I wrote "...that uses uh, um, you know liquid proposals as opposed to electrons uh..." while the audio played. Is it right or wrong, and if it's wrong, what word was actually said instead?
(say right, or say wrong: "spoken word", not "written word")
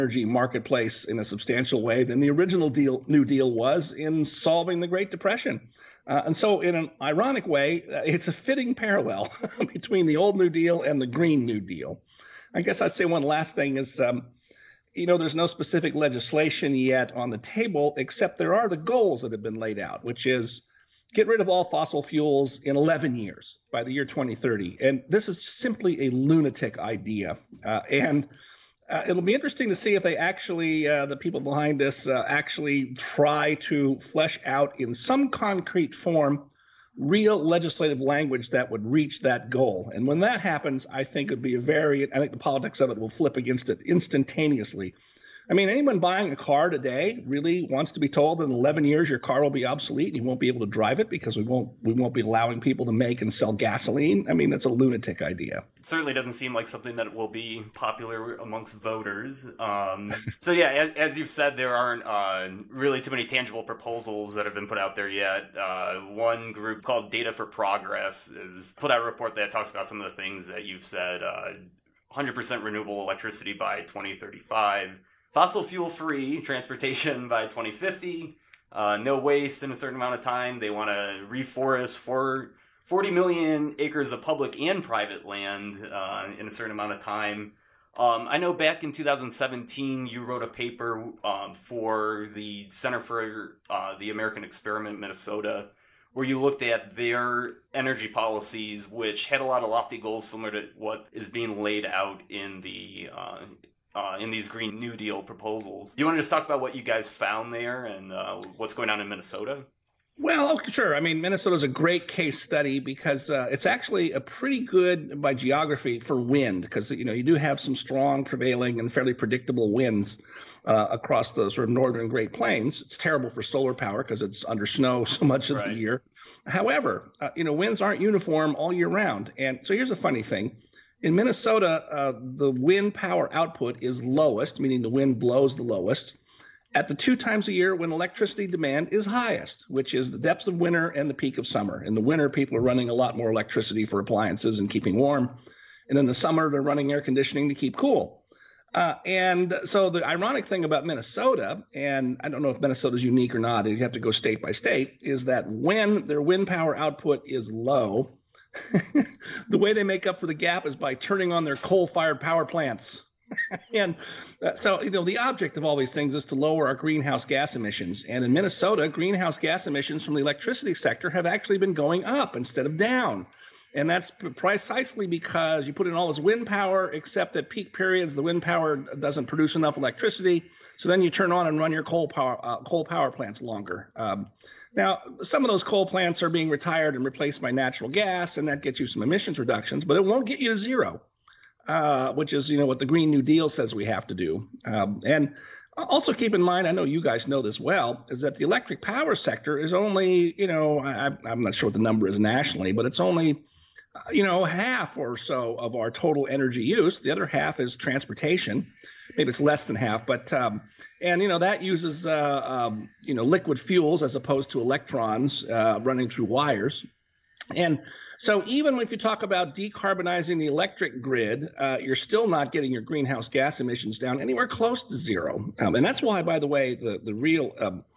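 wrong: "fuels", not "proposals".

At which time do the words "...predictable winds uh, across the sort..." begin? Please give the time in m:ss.
1:59.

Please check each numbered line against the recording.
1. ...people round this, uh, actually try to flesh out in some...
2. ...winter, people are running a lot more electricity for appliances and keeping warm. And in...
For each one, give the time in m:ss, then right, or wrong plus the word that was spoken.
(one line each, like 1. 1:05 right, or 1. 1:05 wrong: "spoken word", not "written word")
1. 0:31 wrong: "behind", not "round"
2. 2:22 right.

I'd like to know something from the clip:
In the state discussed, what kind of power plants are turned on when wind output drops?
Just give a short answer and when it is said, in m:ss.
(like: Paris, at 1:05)
Coal-fired power plants, at 2:41.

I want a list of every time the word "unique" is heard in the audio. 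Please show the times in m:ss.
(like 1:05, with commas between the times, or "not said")
2:33.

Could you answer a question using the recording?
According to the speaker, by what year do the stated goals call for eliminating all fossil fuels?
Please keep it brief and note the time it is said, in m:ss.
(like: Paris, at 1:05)
2030, at 0:24.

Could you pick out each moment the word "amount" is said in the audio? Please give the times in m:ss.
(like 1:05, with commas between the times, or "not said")
1:19, 1:26.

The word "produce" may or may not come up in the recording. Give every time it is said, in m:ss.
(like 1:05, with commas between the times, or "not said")
2:59.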